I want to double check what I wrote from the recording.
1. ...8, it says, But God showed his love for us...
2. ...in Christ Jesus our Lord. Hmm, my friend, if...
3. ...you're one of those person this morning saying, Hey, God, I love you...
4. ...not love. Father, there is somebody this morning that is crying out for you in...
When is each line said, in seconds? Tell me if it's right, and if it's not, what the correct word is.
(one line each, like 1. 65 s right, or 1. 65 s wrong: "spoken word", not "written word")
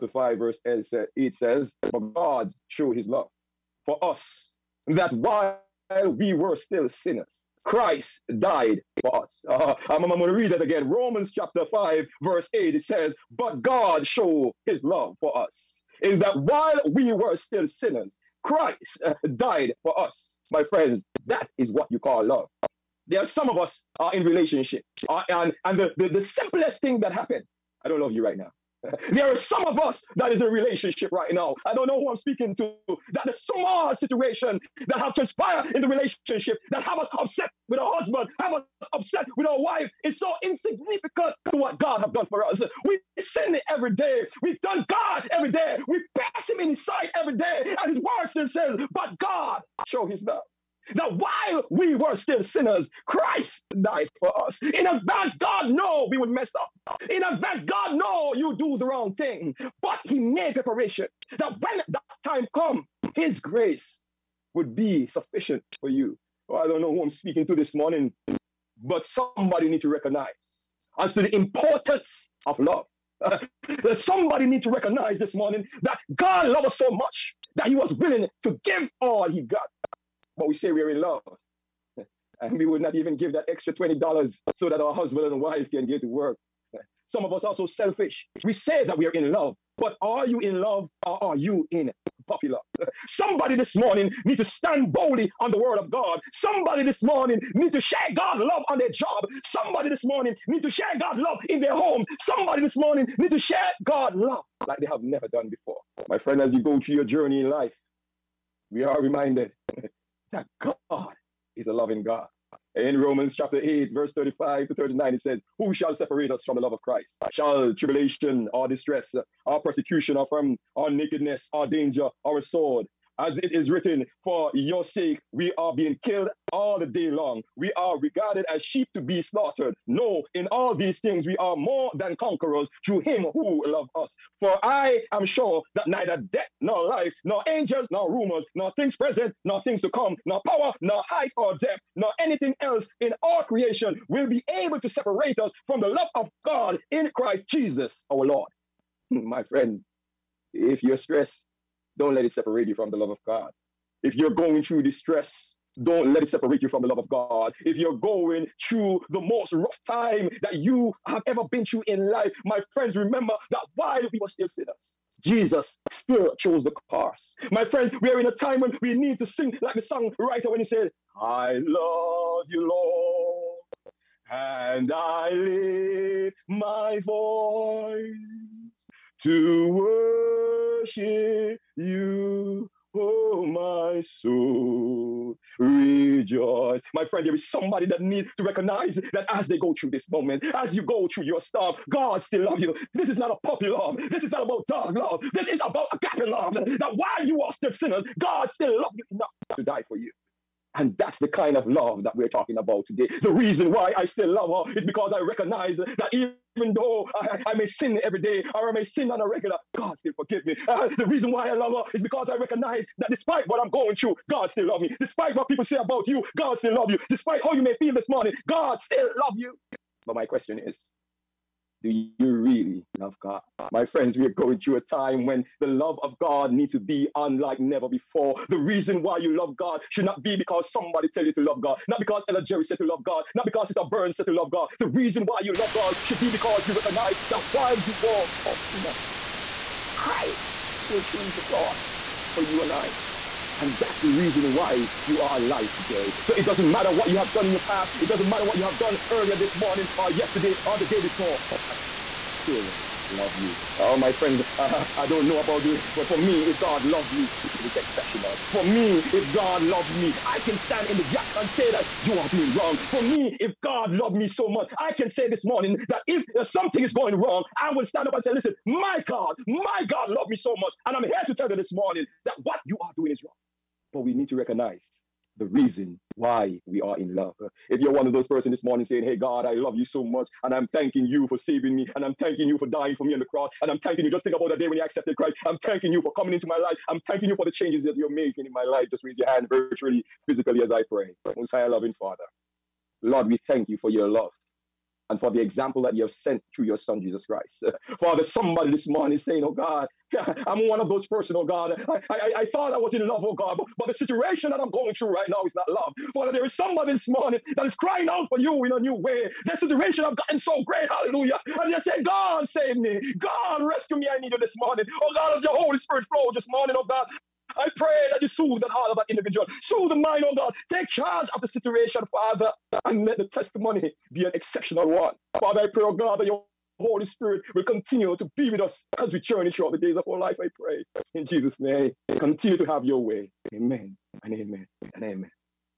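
1. 12 s right
2. 146 s right
3. 277 s right
4. 305 s right.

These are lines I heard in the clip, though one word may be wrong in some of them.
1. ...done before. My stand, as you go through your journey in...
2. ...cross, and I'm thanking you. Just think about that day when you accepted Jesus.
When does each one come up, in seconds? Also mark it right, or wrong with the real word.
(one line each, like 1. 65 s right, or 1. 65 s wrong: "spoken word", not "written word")
1. 105 s wrong: "friend", not "stand"
2. 283 s wrong: "Christ", not "Jesus".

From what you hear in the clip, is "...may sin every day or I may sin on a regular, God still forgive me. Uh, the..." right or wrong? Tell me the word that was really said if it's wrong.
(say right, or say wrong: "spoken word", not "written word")
right.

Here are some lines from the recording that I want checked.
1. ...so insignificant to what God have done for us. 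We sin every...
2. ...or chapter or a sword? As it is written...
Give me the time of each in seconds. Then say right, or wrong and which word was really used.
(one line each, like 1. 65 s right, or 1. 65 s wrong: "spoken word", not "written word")
1. 40 s right
2. 121 s wrong: "danger", not "chapter".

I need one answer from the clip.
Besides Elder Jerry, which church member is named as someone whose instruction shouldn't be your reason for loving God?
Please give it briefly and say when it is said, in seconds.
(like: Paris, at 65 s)
Sister Burns, at 233 s.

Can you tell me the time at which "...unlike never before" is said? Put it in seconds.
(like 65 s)
227 s.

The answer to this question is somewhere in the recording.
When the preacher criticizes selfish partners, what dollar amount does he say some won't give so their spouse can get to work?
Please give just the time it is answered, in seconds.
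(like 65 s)
83 s.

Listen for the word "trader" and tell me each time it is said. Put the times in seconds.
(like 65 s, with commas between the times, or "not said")
not said.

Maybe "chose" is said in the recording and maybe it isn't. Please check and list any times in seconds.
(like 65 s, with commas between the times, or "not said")
166 s, 241 s.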